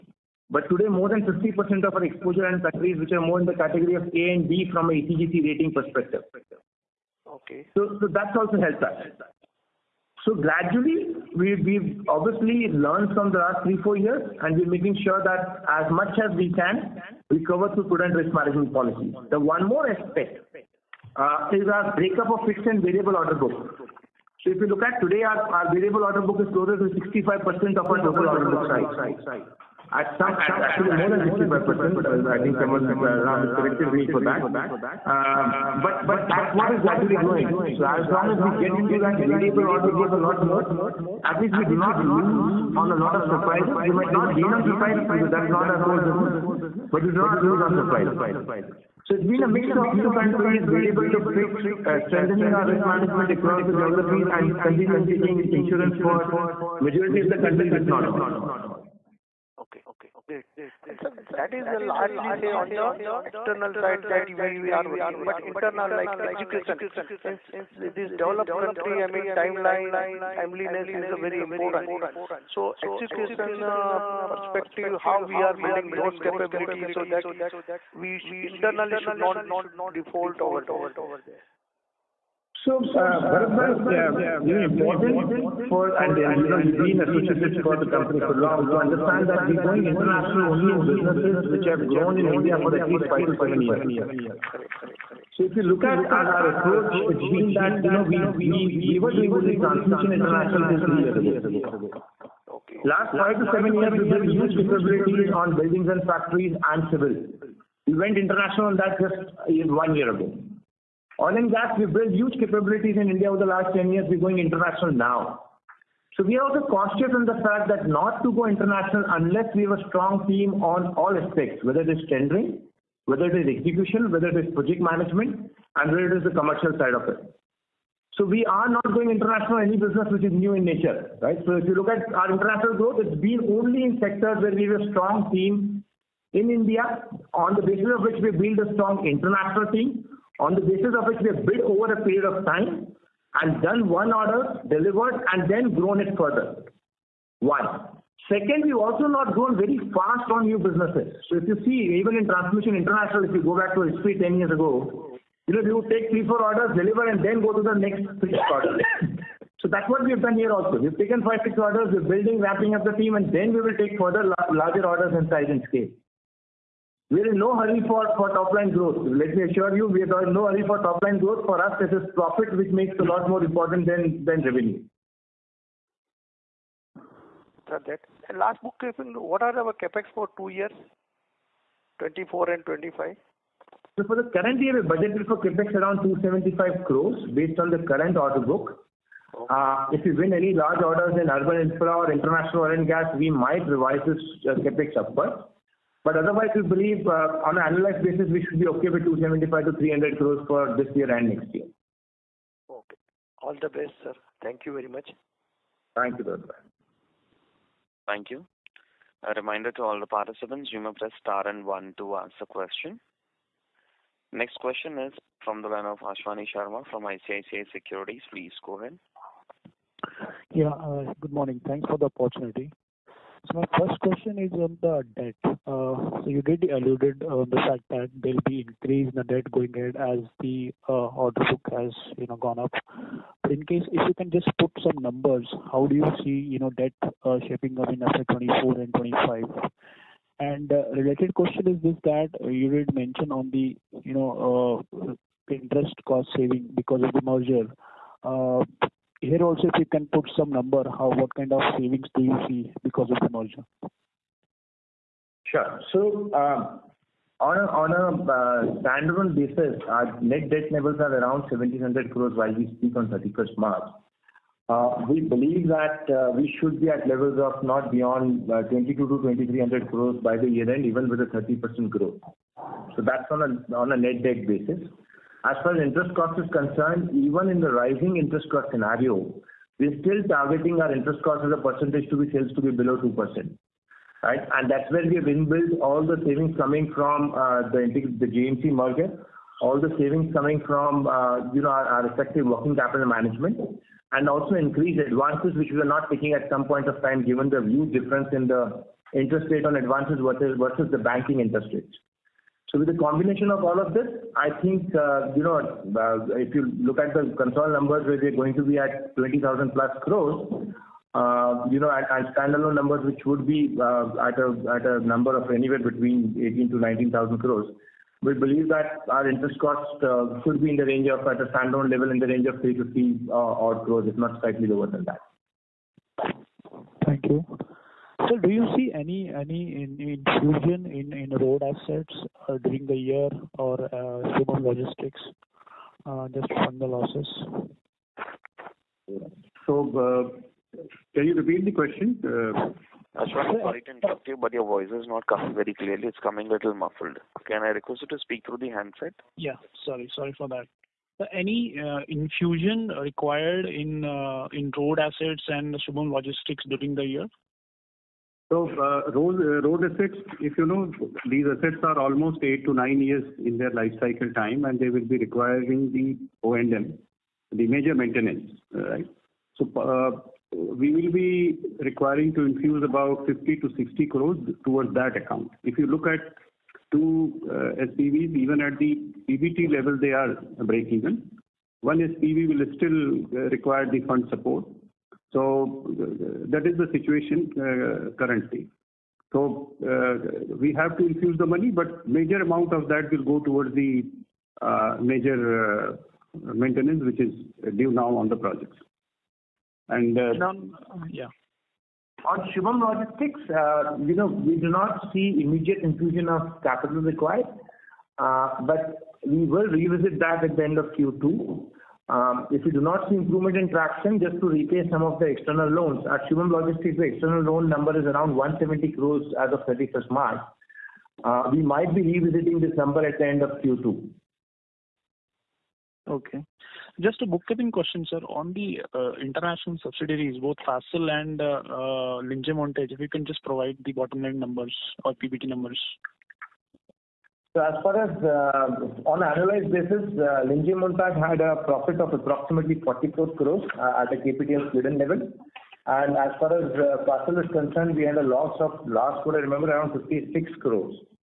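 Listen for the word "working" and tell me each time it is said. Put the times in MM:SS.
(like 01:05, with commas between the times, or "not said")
01:04, 04:52.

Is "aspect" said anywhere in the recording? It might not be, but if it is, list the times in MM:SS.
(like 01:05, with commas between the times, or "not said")
00:19, 02:01.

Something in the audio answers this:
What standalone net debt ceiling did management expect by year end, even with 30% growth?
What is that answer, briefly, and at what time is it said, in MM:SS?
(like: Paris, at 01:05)
2300 crores, at 04:28.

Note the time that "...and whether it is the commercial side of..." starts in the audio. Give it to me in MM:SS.
02:05.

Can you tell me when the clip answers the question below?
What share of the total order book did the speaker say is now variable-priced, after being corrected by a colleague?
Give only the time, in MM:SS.
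00:30.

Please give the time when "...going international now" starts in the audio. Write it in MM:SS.
01:54.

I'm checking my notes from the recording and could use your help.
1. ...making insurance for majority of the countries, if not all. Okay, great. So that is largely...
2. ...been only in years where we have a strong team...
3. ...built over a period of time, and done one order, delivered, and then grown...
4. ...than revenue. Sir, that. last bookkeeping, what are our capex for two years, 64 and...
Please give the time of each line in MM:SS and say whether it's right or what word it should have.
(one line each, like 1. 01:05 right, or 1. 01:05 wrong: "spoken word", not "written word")
1. 00:55 wrong: "taking", not "making"
2. 02:13 wrong: "sectors", not "years"
3. 02:21 right
4. 02:54 wrong: "24", not "64".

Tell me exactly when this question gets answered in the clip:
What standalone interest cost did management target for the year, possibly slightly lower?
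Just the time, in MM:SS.
05:22.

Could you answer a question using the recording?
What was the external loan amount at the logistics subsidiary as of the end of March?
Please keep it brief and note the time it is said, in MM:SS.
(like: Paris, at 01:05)
170 crores, at 06:58.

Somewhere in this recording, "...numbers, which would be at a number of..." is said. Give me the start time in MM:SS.
05:12.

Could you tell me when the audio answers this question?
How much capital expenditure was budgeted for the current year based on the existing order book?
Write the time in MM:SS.
03:06.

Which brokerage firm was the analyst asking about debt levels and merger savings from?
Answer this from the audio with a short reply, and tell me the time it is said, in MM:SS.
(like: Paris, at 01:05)
ICICI Securities, at 03:37.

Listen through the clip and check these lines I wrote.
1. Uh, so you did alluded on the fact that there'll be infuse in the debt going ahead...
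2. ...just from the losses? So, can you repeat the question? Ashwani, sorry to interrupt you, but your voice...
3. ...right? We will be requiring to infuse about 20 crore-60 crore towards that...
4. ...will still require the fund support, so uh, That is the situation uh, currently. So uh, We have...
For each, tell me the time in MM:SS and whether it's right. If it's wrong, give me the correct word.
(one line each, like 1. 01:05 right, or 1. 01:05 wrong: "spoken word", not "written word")
1. 03:45 wrong: "increase", not "infuse"
2. 05:36 right
3. 06:08 wrong: "50", not "20"
4. 06:22 right.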